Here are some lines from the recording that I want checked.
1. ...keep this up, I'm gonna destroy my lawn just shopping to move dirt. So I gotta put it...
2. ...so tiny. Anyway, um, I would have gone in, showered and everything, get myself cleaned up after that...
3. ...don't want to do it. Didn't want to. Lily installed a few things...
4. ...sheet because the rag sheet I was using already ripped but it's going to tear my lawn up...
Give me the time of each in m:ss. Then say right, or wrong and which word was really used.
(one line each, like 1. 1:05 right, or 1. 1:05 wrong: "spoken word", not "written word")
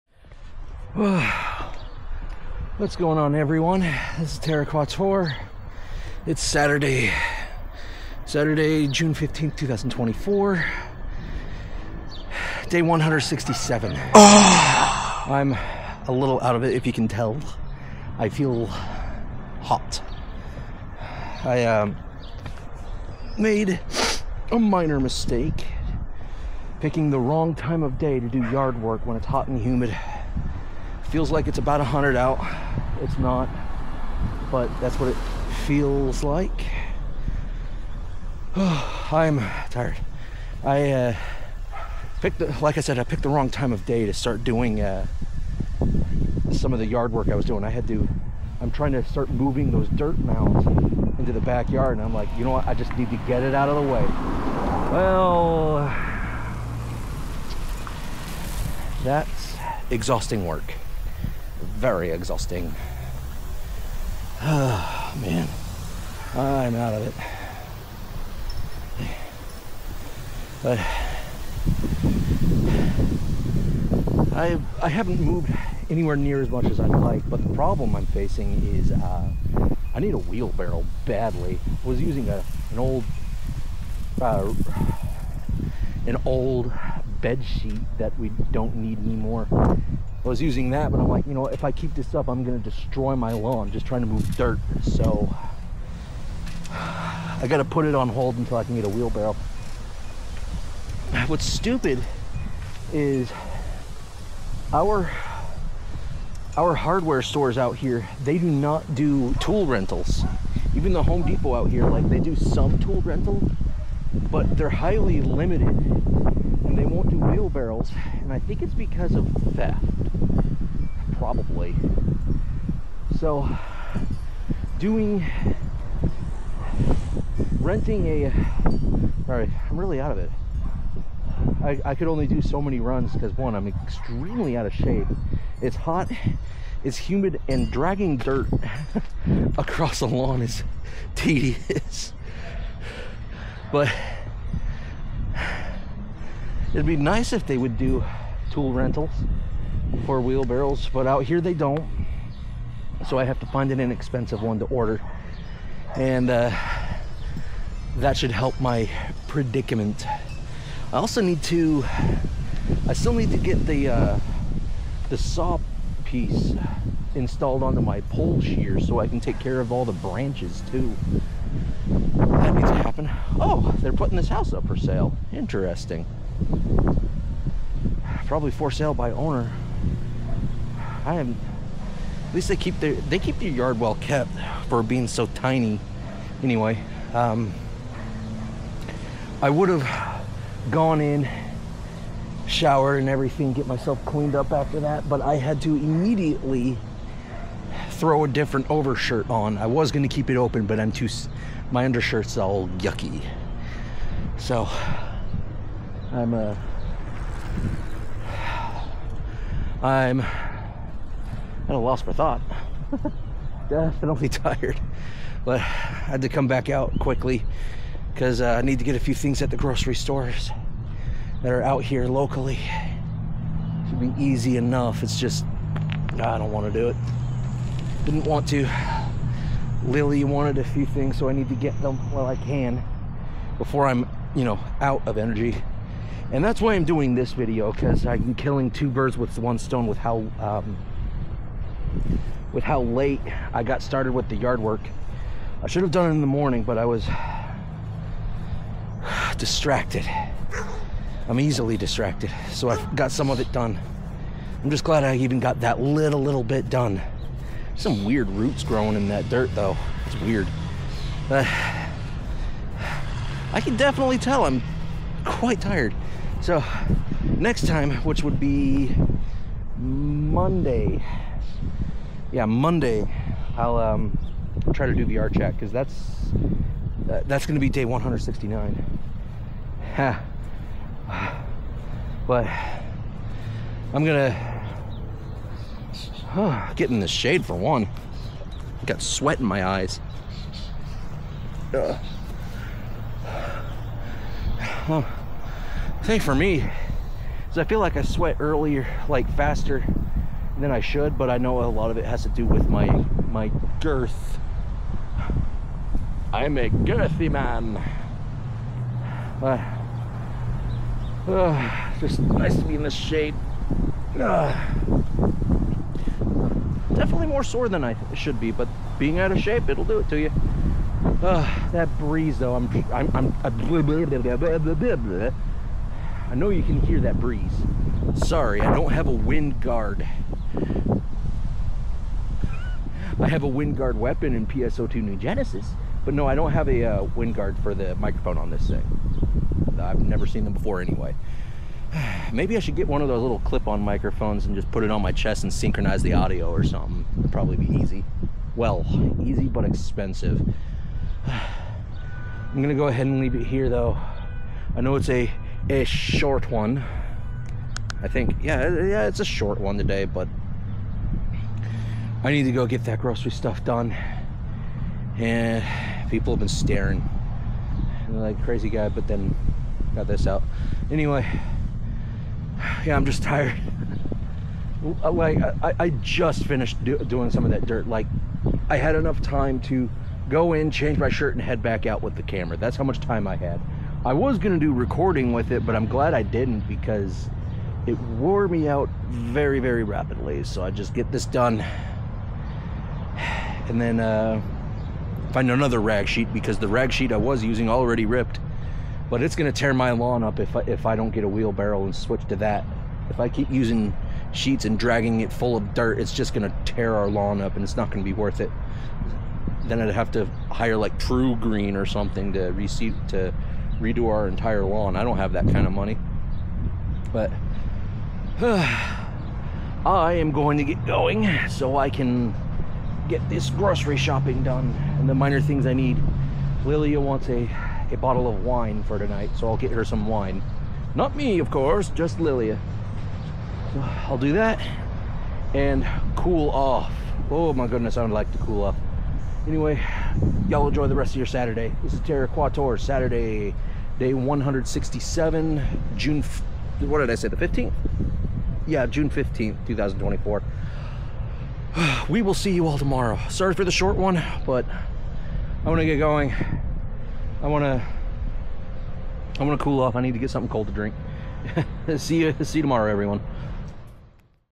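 1. 1:31 wrong: "trying", not "shopping"
2. 3:05 right
3. 3:46 wrong: "wanted", not "installed"
4. 6:36 right.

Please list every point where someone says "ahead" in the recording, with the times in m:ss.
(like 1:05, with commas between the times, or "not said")
5:52.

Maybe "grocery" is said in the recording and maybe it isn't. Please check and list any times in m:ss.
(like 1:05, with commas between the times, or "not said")
3:39, 6:02, 7:03.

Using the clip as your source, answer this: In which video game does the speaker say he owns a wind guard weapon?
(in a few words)
PSO2 New Genesis.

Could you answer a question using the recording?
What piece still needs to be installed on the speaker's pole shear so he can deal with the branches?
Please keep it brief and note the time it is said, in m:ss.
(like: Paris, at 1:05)
The saw piece, at 2:45.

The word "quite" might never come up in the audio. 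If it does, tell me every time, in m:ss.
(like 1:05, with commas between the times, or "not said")
4:25.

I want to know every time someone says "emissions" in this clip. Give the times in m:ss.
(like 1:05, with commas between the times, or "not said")
not said.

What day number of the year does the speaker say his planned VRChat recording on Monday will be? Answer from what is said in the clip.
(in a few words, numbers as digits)
169.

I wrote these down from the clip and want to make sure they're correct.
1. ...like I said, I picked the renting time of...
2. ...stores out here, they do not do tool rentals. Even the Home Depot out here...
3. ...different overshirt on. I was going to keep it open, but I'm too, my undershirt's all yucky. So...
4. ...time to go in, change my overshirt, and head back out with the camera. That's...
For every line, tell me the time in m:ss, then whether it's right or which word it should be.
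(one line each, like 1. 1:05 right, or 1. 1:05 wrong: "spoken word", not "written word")
1. 0:42 wrong: "wrong", not "renting"
2. 1:47 right
3. 3:18 right
4. 6:19 wrong: "shirt", not "overshirt".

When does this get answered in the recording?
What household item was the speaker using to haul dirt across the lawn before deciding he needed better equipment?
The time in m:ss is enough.
1:26.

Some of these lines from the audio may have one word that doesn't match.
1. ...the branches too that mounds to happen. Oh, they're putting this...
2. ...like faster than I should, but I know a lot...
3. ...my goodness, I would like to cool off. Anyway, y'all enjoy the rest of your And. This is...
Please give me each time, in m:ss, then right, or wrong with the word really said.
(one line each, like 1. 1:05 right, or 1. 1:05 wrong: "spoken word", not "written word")
1. 2:49 wrong: "needs", not "mounds"
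2. 4:59 right
3. 7:17 wrong: "Saturday", not "And".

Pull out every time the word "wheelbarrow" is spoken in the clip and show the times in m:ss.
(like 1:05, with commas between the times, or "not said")
1:20, 1:38, 1:57, 2:30, 6:41.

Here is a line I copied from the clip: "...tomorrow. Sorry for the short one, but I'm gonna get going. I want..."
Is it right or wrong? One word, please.
right.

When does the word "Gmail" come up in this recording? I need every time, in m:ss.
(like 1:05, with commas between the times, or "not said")
not said.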